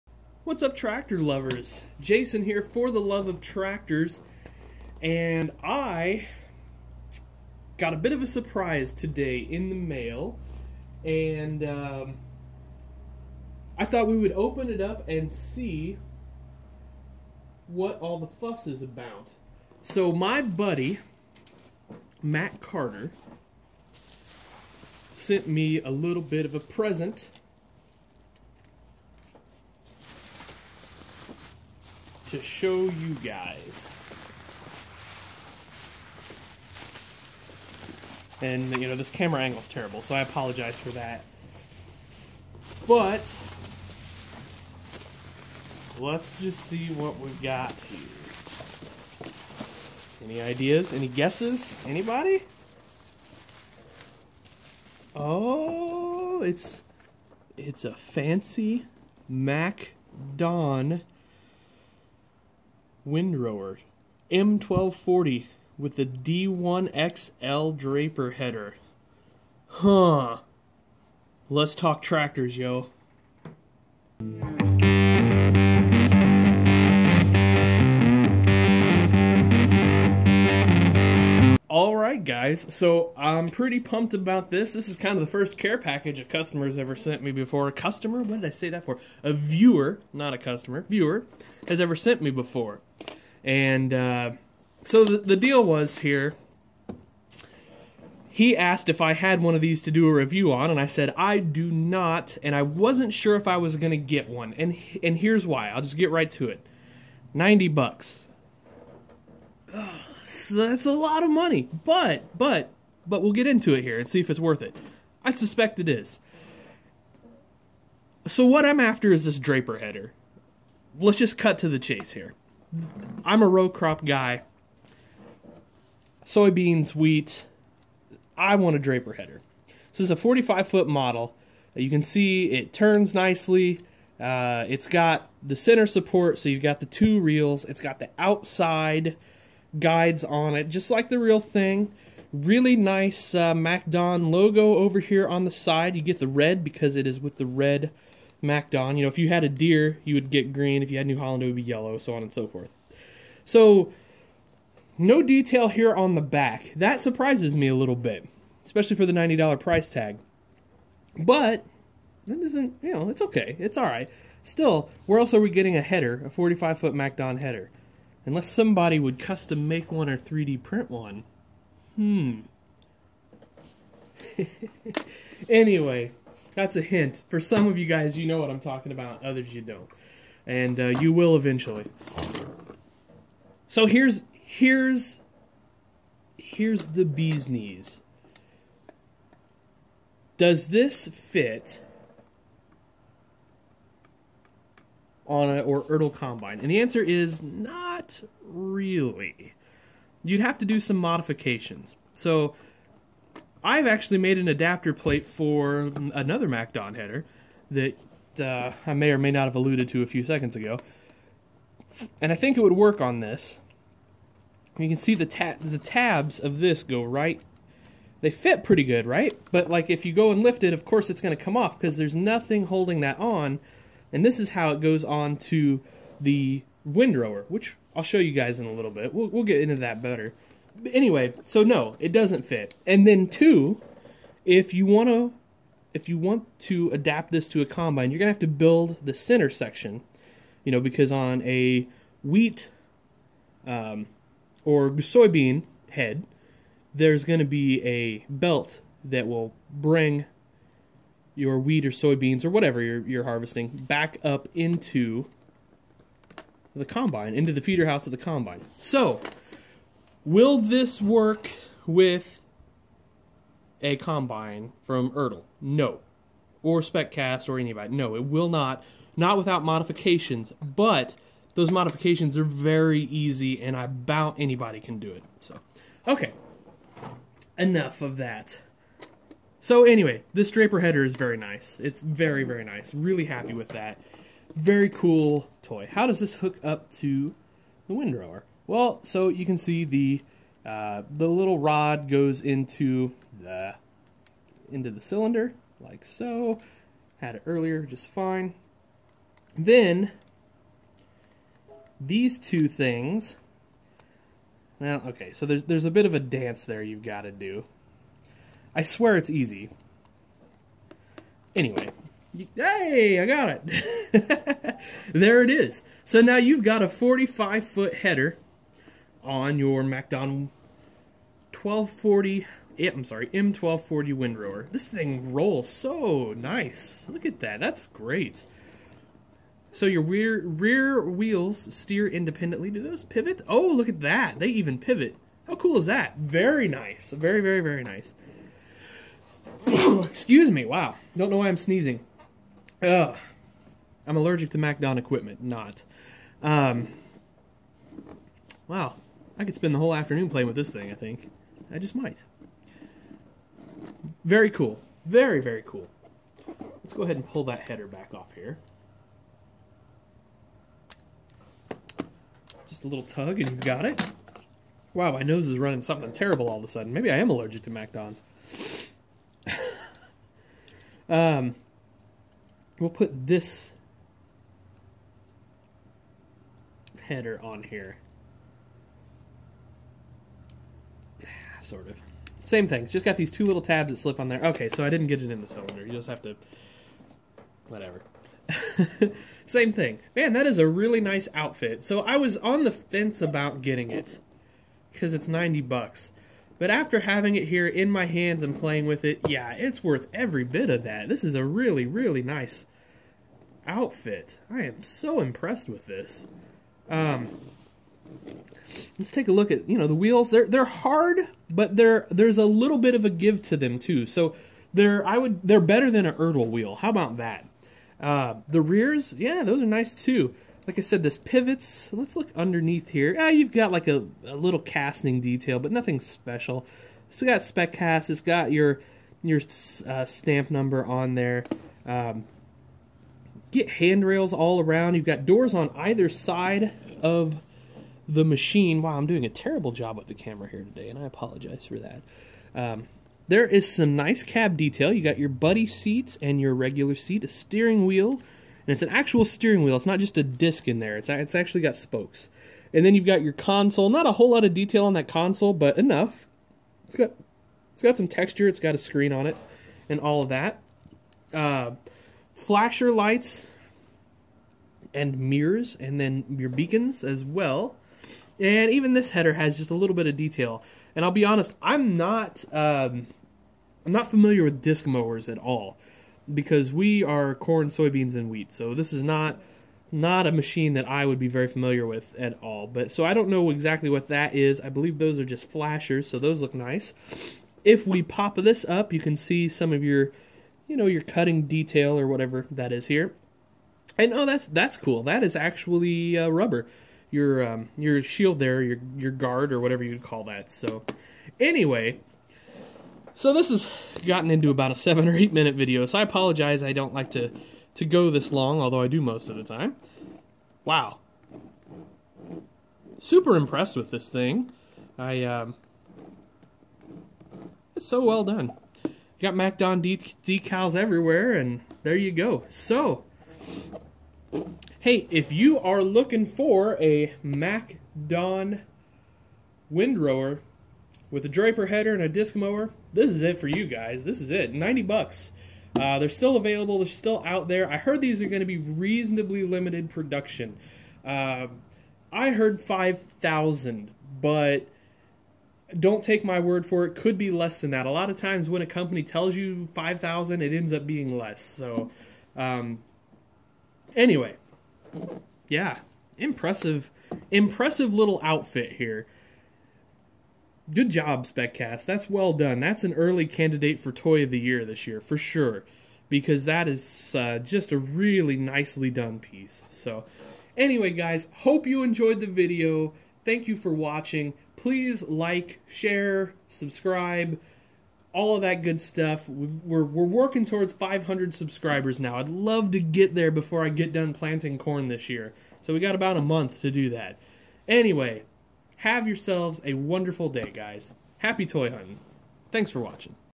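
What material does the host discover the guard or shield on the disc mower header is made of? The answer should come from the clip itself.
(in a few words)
rubber.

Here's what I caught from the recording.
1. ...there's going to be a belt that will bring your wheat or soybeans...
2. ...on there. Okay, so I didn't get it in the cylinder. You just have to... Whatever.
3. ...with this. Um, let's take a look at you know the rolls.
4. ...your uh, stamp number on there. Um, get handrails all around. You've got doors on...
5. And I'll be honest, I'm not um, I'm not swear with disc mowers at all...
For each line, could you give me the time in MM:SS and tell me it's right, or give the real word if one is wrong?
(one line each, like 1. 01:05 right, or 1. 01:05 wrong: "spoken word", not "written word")
1. 04:06 right
2. 06:24 right
3. 06:45 wrong: "wheels", not "rolls"
4. 07:09 right
5. 07:50 wrong: "familiar", not "swear".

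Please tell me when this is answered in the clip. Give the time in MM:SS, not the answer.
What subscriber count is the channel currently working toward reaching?
09:40.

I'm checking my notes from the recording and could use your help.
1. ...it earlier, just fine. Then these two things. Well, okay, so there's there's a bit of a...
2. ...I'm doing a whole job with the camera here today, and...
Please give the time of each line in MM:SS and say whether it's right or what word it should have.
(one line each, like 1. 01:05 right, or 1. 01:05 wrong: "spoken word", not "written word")
1. 04:57 right
2. 07:18 wrong: "terrible", not "whole".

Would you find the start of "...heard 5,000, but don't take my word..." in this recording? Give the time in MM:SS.
09:02.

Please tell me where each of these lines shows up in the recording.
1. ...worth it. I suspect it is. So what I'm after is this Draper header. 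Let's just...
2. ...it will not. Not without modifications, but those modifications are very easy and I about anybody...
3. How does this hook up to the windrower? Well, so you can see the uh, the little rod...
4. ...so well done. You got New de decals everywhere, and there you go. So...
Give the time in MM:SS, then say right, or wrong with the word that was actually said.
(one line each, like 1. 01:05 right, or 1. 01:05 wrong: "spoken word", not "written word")
1. 01:54 right
2. 04:28 right
3. 04:45 right
4. 08:37 wrong: "MacDon", not "New".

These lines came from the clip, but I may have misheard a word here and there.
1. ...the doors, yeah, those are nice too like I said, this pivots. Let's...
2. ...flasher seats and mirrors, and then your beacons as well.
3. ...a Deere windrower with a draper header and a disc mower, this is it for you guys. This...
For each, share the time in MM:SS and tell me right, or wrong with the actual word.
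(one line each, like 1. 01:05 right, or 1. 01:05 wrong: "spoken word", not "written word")
1. 06:58 wrong: "rears", not "doors"
2. 07:42 wrong: "lights", not "seats"
3. 08:46 wrong: "MacDon", not "Deere".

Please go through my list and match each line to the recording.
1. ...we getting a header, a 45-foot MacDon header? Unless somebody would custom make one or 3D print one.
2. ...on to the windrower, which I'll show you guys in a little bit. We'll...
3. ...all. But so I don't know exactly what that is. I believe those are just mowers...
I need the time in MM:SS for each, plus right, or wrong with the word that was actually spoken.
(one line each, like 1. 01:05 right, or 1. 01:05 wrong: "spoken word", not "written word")
1. 02:45 right
2. 03:45 right
3. 08:02 wrong: "flashers", not "mowers".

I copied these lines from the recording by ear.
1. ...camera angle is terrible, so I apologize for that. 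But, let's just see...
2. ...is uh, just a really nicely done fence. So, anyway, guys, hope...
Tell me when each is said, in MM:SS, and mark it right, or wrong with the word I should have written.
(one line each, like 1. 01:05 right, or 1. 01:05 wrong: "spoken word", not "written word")
1. 00:39 right
2. 09:26 wrong: "piece", not "fence".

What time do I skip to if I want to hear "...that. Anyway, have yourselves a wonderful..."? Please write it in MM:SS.
09:46.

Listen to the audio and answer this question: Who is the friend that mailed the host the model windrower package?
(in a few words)
Matt Carter.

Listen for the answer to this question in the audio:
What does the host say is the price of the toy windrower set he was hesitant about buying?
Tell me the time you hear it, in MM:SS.
01:47.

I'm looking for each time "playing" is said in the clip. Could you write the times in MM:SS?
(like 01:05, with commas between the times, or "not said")
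05:50, 06:38.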